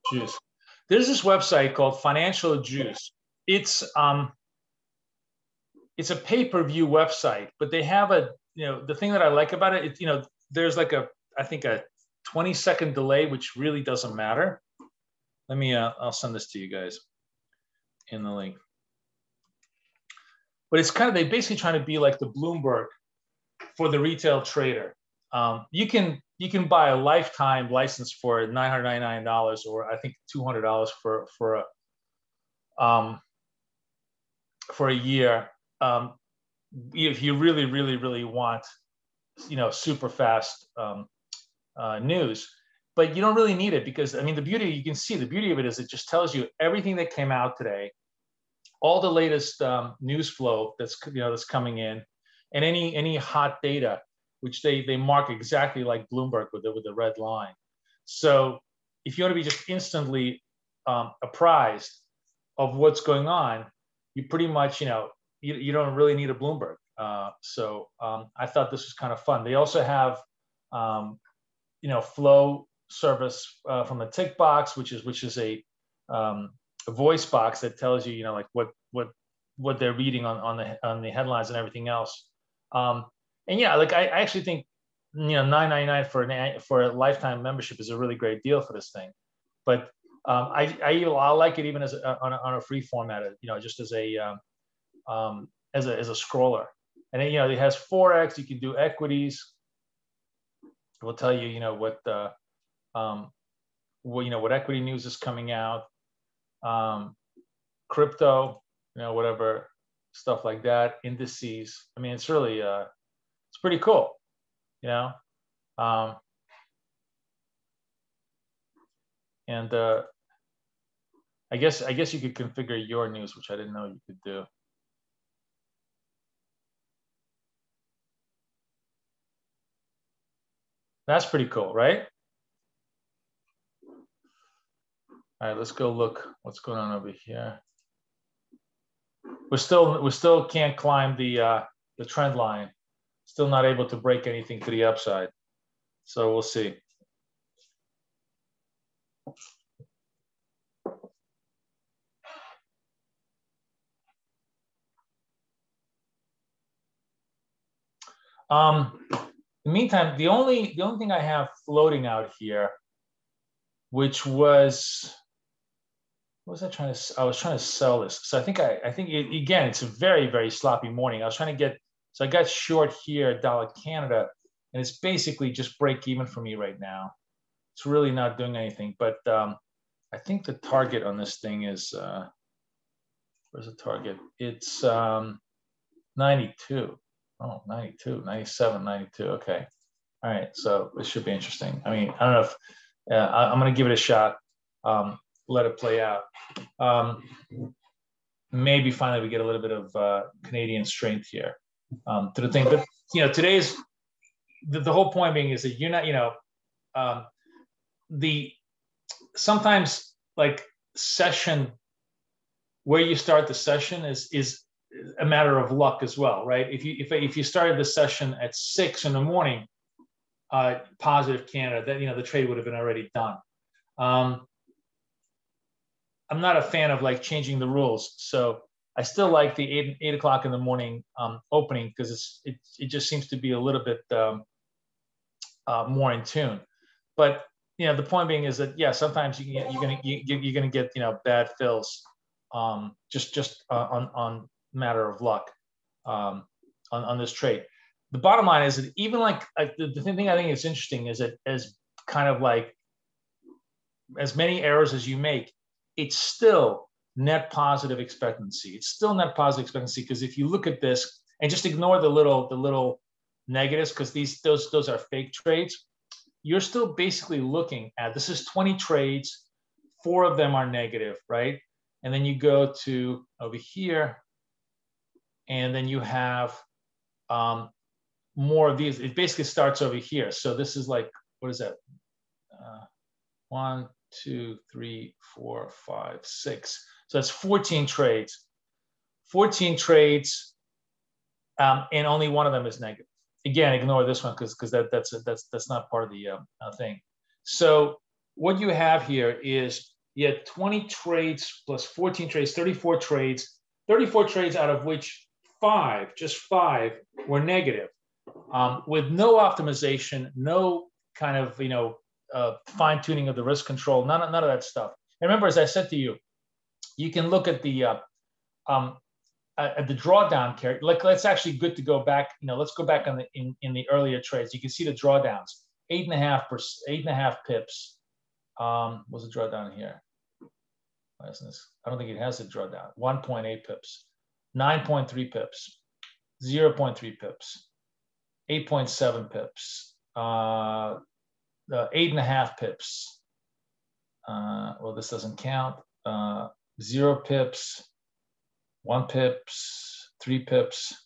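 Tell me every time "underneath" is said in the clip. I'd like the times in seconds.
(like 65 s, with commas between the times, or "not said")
not said.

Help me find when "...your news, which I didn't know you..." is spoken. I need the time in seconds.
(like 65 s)
122 s.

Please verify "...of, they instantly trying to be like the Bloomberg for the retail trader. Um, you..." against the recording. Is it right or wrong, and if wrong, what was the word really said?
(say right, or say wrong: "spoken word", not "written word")
wrong: "basically", not "instantly".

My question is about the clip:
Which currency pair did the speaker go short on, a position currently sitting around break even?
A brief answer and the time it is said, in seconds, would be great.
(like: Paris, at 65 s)
Dollar Canada, at 173 s.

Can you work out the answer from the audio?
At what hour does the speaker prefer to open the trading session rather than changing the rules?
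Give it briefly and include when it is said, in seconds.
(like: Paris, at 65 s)
8 o'clock, at 230 s.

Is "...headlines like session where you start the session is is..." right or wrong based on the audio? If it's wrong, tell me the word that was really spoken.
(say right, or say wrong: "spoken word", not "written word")
wrong: "sometimes", not "headlines".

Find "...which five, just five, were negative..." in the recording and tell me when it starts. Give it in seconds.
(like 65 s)
304 s.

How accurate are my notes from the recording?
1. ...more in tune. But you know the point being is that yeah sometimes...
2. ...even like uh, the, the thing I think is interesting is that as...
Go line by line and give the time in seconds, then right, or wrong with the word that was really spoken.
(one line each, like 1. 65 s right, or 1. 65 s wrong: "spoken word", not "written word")
1. 235 s right
2. 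248 s right.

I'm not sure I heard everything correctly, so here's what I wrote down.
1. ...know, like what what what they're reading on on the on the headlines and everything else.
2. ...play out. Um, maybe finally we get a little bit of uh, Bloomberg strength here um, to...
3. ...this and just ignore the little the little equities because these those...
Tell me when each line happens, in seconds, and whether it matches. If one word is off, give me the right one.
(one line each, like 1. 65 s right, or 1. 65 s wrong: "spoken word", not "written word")
1. 78 s right
2. 195 s wrong: "Canadian", not "Bloomberg"
3. 260 s wrong: "negatives", not "equities".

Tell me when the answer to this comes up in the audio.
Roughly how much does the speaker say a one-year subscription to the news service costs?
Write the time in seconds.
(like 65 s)
30 s.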